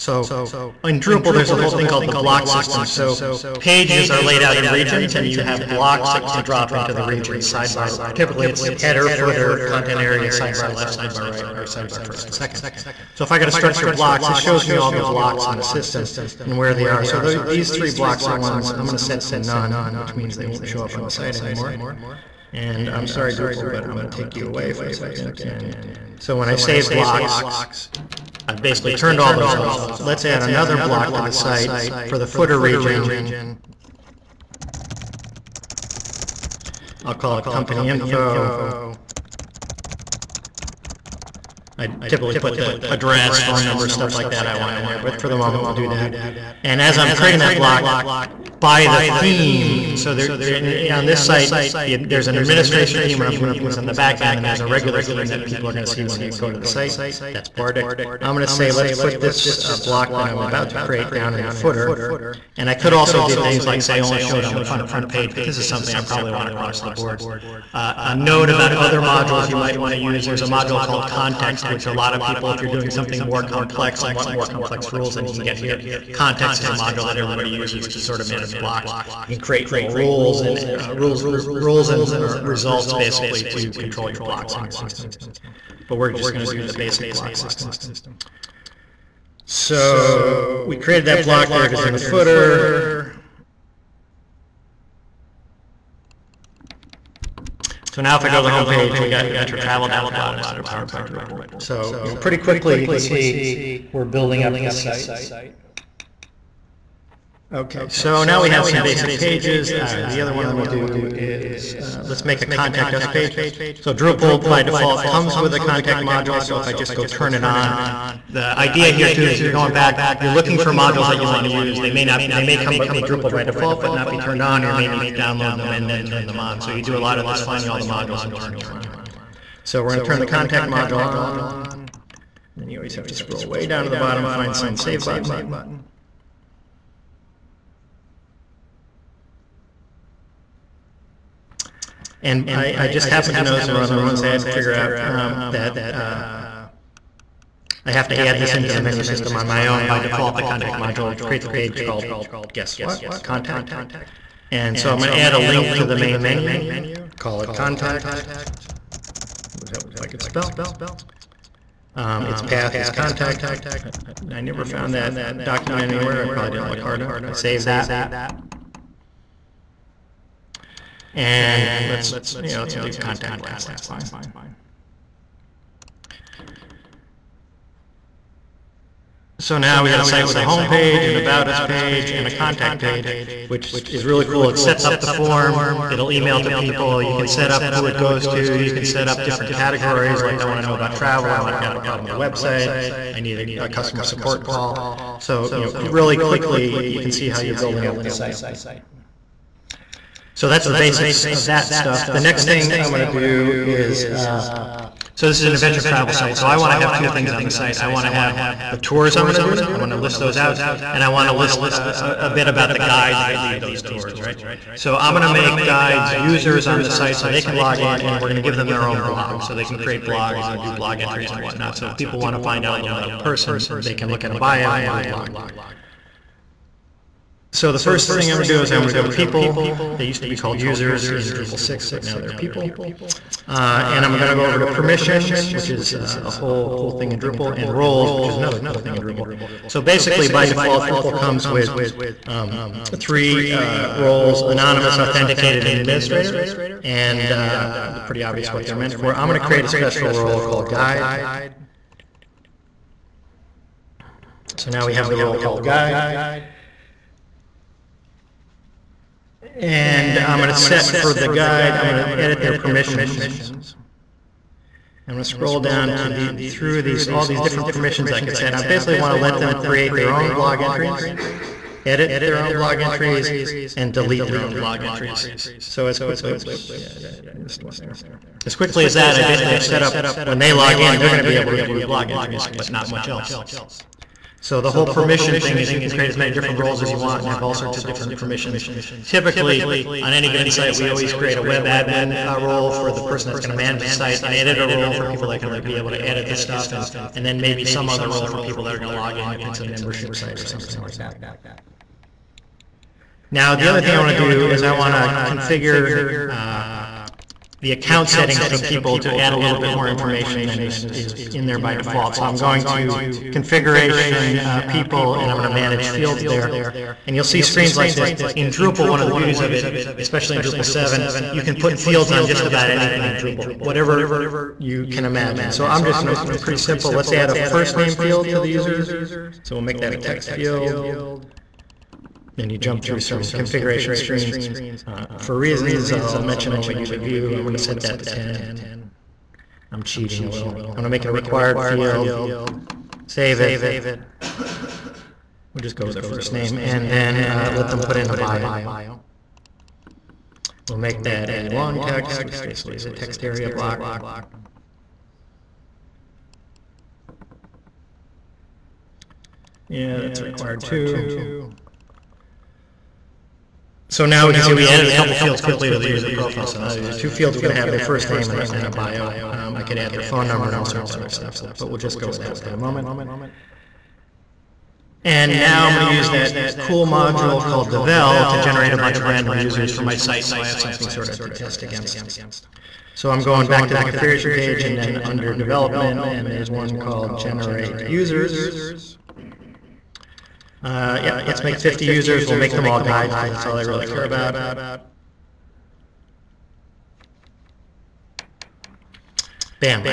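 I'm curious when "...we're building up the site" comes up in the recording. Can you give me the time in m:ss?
1:43.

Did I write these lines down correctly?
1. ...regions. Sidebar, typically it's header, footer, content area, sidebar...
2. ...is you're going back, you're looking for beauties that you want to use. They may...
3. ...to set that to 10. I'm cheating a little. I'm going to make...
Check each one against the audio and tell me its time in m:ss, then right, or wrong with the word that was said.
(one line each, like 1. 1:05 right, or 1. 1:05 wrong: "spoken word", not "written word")
1. 0:07 right
2. 1:59 wrong: "modules", not "beauties"
3. 5:37 right.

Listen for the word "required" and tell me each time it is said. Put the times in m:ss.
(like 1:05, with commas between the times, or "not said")
5:41, 6:00.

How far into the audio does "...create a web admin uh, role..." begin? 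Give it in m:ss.
4:51.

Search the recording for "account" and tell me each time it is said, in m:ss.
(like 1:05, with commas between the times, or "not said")
5:07.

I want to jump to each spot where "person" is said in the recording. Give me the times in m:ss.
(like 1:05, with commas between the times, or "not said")
3:43, 4:53.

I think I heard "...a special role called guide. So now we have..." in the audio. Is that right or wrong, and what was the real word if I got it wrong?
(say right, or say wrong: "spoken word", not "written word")
right.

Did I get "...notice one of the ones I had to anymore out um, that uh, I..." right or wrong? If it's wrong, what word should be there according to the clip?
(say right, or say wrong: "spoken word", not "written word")
wrong: "figure", not "anymore".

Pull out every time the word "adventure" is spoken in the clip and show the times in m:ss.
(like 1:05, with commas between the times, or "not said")
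1:39, 3:25.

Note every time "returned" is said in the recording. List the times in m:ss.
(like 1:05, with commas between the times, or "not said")
not said.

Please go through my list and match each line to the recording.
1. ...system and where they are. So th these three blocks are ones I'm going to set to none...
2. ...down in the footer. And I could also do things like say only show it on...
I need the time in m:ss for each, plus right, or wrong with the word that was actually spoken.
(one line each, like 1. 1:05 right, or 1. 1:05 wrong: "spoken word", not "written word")
1. 0:15 right
2. 1:01 right.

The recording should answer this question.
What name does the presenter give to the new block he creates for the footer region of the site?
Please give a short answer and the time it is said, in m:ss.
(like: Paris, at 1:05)
Company info, at 0:37.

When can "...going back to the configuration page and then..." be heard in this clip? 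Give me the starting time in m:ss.
6:23.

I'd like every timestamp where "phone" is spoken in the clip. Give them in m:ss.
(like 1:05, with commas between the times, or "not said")
0:43, 6:10.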